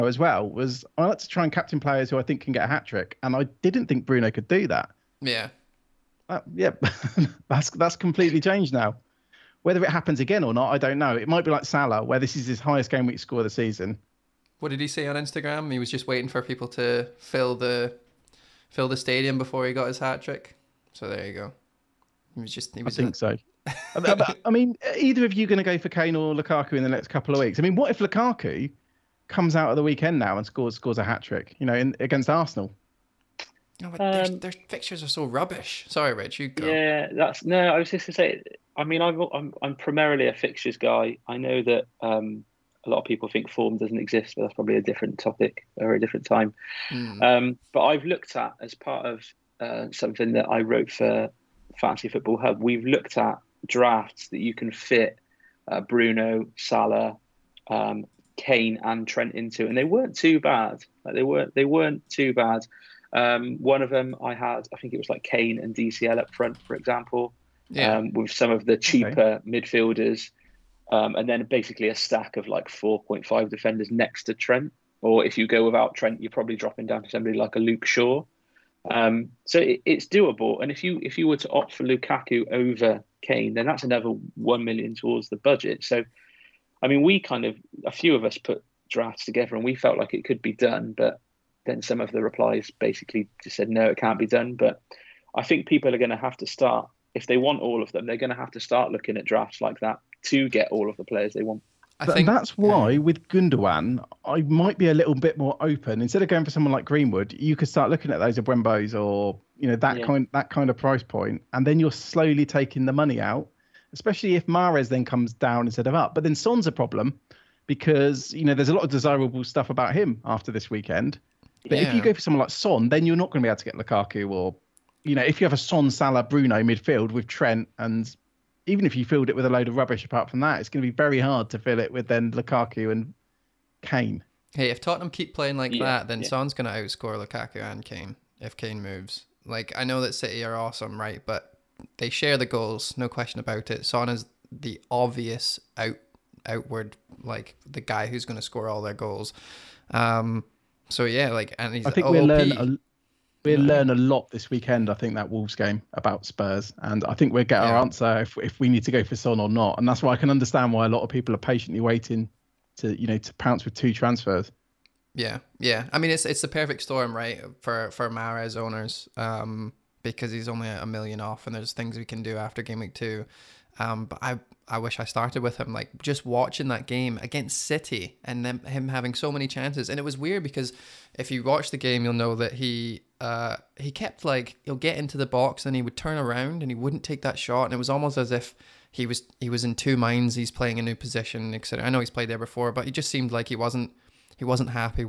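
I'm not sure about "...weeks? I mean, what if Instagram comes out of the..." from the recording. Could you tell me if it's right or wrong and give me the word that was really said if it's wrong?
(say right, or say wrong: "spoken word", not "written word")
wrong: "Lukaku", not "Instagram".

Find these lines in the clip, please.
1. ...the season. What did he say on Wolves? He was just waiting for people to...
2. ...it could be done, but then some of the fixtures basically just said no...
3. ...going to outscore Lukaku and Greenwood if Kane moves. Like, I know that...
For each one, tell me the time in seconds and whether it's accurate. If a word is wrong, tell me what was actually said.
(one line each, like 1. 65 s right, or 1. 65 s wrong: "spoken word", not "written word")
1. 13 s wrong: "Instagram", not "Wolves"
2. 90 s wrong: "replies", not "fixtures"
3. 136 s wrong: "Kane", not "Greenwood".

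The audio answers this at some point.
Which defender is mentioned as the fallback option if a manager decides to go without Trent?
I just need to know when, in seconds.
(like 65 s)
77 s.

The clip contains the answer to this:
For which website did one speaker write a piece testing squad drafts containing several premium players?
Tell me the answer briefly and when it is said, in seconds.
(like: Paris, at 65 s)
Fantasy Football Hub, at 51 s.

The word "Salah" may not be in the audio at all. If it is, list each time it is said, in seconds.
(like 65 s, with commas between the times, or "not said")
11 s, 56 s, 125 s.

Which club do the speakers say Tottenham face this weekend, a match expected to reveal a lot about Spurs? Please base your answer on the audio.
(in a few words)
Wolves.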